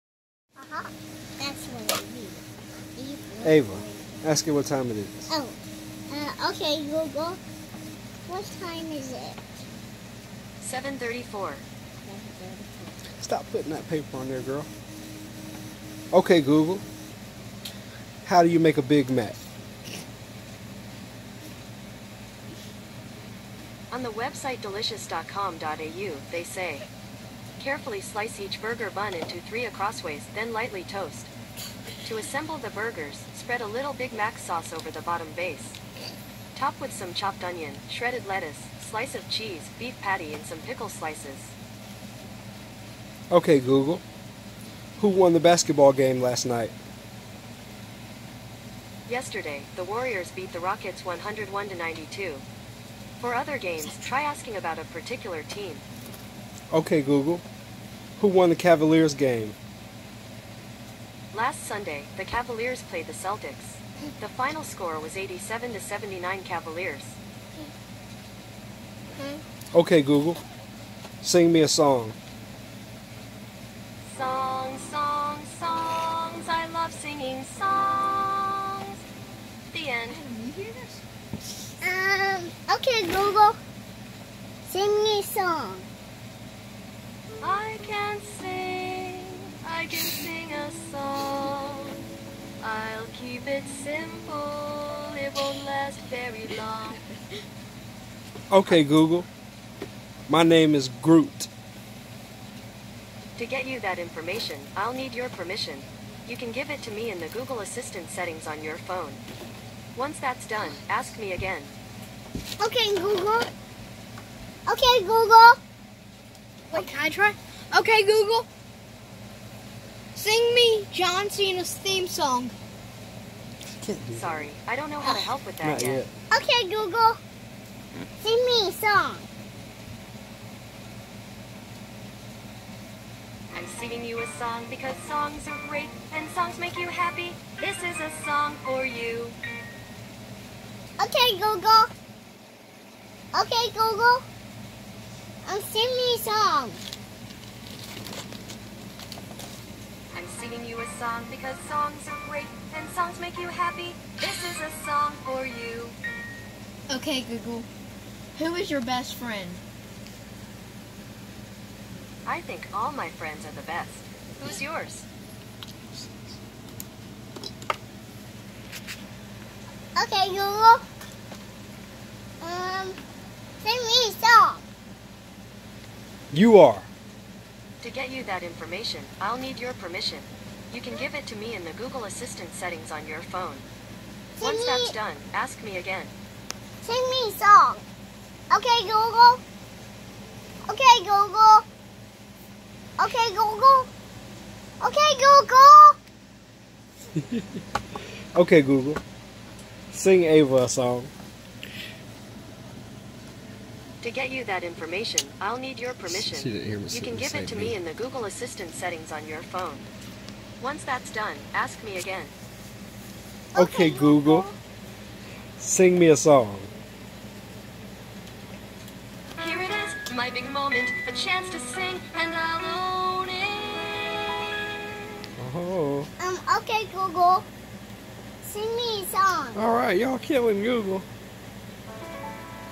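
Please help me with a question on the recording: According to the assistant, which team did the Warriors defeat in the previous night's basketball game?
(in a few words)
Rockets.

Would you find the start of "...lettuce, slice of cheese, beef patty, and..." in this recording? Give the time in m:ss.
0:38.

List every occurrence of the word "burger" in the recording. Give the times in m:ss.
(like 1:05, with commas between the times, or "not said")
0:28, 0:32.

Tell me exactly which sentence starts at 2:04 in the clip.
Sorry, I don't know how to help with that yet.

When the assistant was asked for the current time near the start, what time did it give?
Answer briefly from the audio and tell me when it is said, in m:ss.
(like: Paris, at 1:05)
7:34, at 0:10.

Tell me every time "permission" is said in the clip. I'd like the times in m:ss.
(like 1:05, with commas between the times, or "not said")
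1:45, 2:59, 3:25.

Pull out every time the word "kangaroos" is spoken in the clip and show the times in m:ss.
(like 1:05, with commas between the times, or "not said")
not said.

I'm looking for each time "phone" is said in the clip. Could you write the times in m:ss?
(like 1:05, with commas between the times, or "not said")
1:48, 3:03, 3:29.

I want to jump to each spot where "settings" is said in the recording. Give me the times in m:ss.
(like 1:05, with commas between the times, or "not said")
1:48, 3:02, 3:28.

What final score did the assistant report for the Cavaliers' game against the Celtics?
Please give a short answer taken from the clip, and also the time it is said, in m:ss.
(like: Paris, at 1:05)
87 to 79, at 1:05.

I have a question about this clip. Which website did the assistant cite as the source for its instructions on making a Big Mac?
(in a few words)
delicious.com.au.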